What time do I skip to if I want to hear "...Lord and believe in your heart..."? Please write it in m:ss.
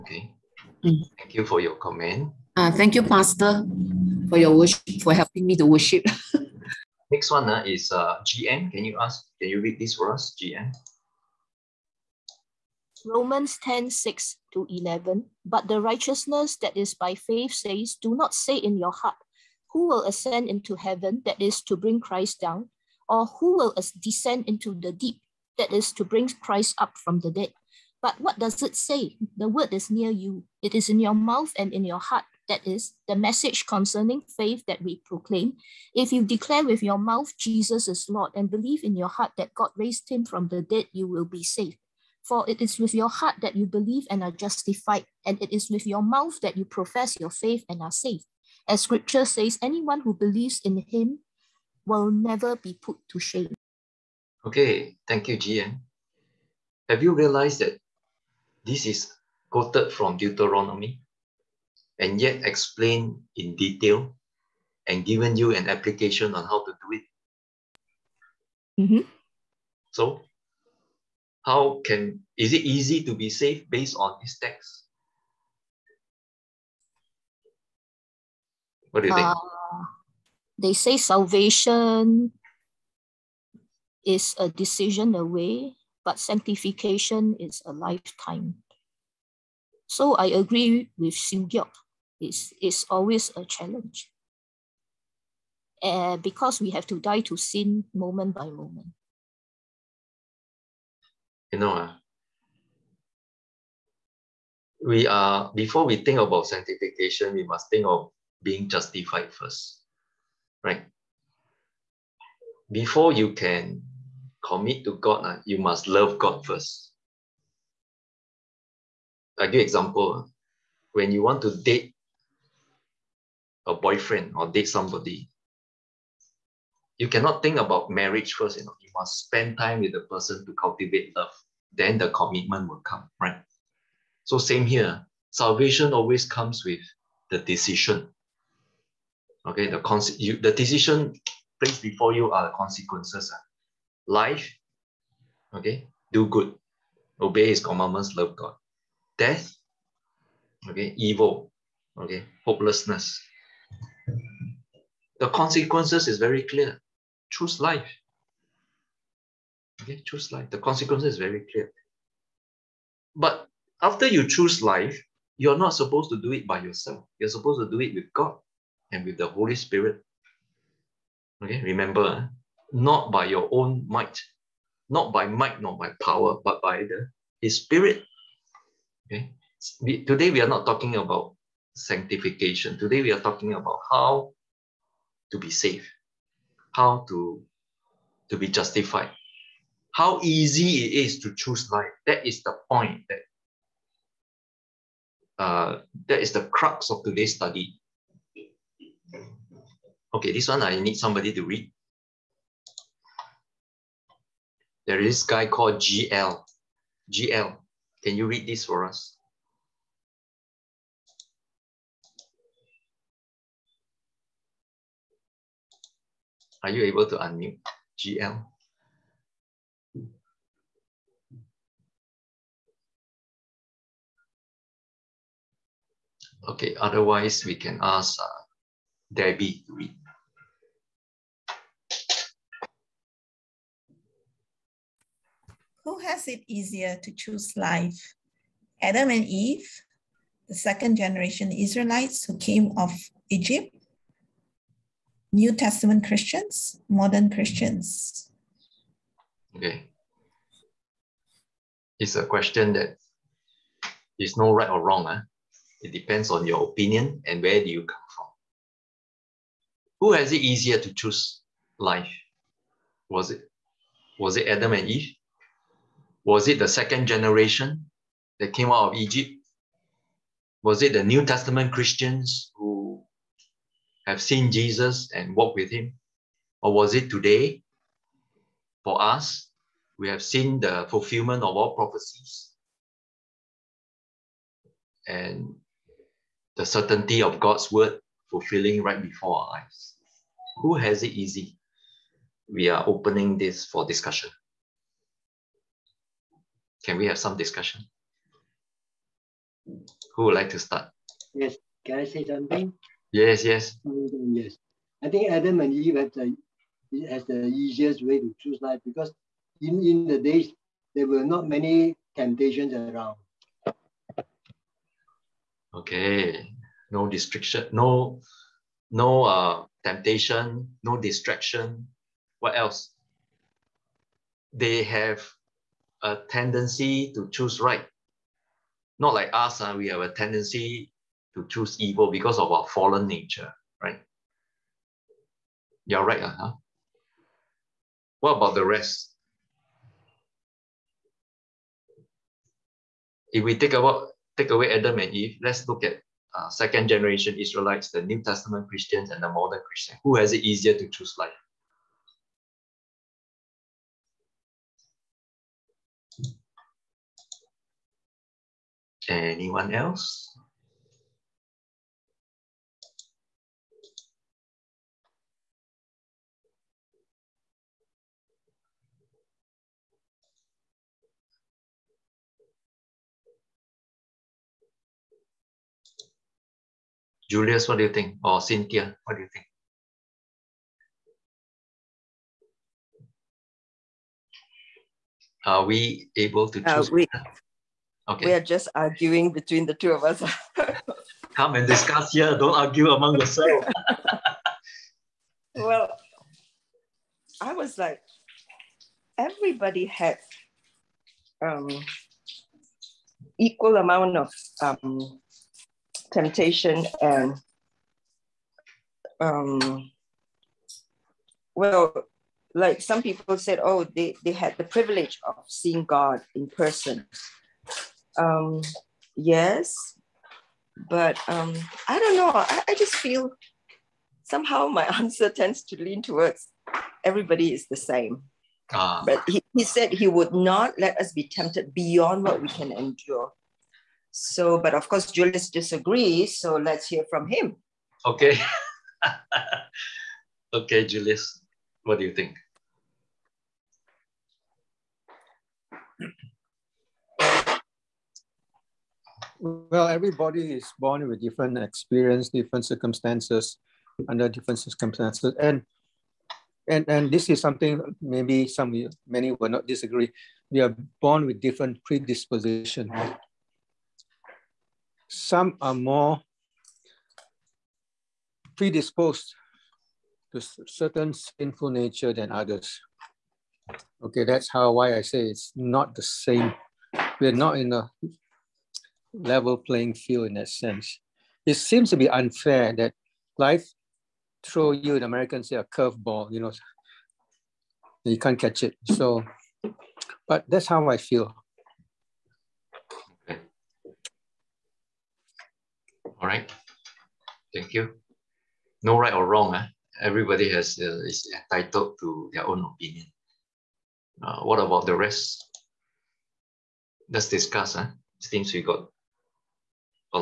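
0:38.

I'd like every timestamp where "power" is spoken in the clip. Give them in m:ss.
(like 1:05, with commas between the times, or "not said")
2:56.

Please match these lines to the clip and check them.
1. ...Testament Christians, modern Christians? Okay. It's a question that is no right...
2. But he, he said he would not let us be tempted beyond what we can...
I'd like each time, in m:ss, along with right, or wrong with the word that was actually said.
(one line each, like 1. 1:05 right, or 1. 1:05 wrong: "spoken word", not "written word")
1. 4:05 right
2. 7:09 right.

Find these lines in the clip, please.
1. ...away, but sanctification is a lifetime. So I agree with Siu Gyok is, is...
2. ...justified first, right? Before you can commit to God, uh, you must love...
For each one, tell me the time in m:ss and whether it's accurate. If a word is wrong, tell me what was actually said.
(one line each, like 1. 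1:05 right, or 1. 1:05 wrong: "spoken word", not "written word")
1. 1:25 right
2. 1:48 right.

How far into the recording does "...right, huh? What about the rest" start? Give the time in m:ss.
5:36.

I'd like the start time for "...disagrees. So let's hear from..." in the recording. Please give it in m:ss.
7:15.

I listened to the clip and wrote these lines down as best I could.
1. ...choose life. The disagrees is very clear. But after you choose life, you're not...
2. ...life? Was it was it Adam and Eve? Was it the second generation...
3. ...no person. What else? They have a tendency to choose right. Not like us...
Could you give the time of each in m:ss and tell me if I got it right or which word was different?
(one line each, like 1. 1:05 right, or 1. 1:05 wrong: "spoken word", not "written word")
1. 2:40 wrong: "consequences", not "disagrees"
2. 4:21 right
3. 5:20 wrong: "distraction", not "person".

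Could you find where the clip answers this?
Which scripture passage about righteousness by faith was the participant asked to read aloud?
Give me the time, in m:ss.
0:13.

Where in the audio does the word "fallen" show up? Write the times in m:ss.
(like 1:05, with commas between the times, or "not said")
5:32.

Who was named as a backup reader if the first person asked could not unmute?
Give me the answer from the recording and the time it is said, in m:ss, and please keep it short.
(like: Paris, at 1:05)
Debbie, at 3:49.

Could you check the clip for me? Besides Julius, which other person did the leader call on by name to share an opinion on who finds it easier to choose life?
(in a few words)
Cynthia.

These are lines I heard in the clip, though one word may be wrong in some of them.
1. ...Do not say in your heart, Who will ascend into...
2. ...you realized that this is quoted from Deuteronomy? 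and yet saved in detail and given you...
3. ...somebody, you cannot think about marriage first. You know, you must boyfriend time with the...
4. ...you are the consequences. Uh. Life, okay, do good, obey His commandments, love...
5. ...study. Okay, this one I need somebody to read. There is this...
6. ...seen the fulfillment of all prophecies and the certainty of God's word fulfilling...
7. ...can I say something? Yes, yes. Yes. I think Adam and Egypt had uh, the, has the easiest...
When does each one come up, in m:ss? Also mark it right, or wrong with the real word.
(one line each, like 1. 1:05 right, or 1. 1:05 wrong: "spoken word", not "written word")
1. 0:17 right
2. 0:57 wrong: "explained", not "saved"
3. 2:04 wrong: "spend", not "boyfriend"
4. 2:22 right
5. 3:17 right
6. 4:40 right
7. 5:01 wrong: "Eve", not "Egypt".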